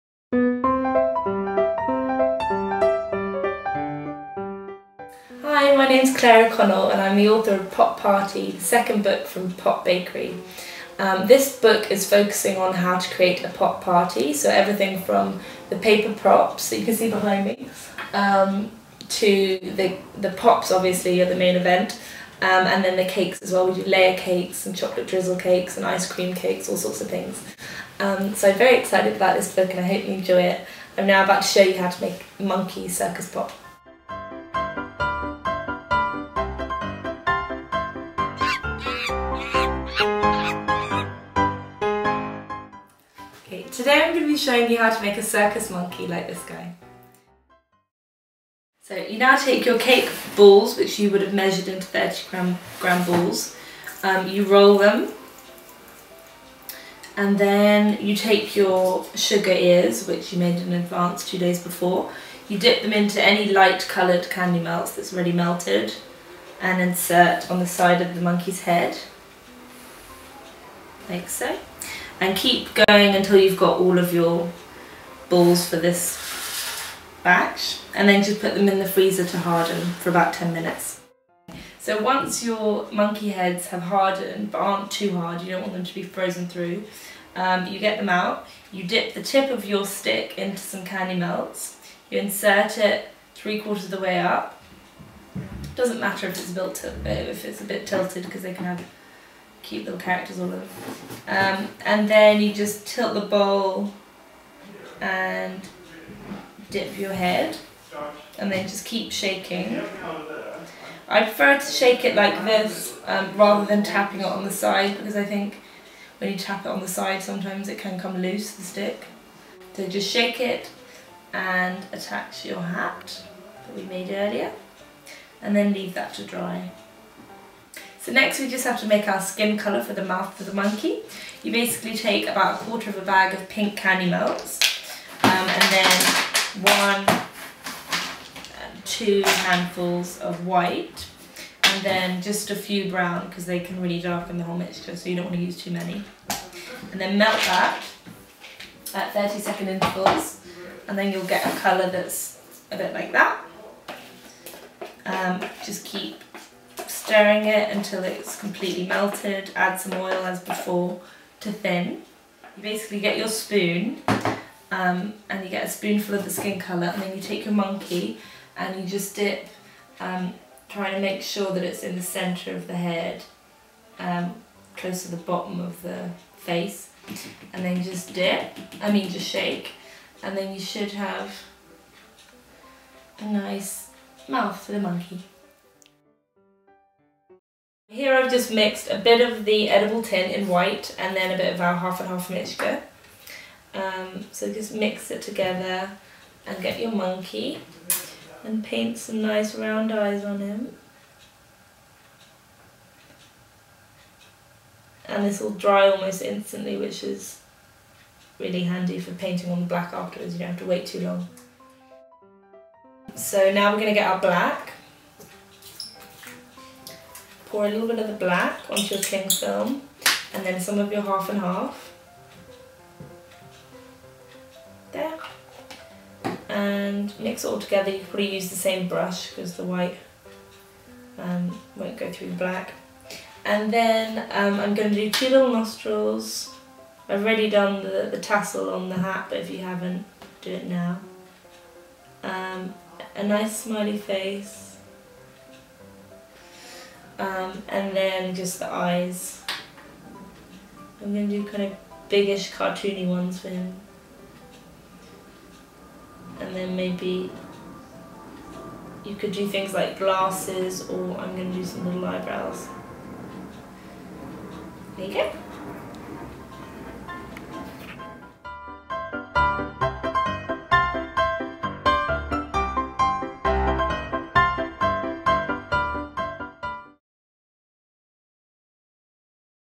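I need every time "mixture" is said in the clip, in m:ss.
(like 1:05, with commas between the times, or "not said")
2:24, 3:12.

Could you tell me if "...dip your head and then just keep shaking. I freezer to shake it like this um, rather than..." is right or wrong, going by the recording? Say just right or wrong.
wrong.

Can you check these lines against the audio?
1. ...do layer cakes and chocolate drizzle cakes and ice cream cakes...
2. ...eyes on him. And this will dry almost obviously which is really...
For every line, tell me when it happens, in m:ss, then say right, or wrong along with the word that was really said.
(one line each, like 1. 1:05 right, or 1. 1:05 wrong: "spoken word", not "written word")
1. 0:23 right
2. 3:19 wrong: "instantly", not "obviously".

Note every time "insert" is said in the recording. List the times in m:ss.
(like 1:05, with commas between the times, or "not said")
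1:06, 1:32.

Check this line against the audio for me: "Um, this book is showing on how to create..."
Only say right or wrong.
wrong.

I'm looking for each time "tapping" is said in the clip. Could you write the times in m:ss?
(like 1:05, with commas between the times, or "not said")
1:53.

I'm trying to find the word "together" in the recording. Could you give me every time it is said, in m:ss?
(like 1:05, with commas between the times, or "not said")
3:15, 3:47.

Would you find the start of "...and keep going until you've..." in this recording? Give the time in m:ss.
1:12.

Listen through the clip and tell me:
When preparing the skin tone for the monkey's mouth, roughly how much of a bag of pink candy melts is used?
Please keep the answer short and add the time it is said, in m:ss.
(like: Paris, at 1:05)
a quarter, at 2:12.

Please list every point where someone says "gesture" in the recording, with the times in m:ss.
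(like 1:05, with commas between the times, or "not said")
not said.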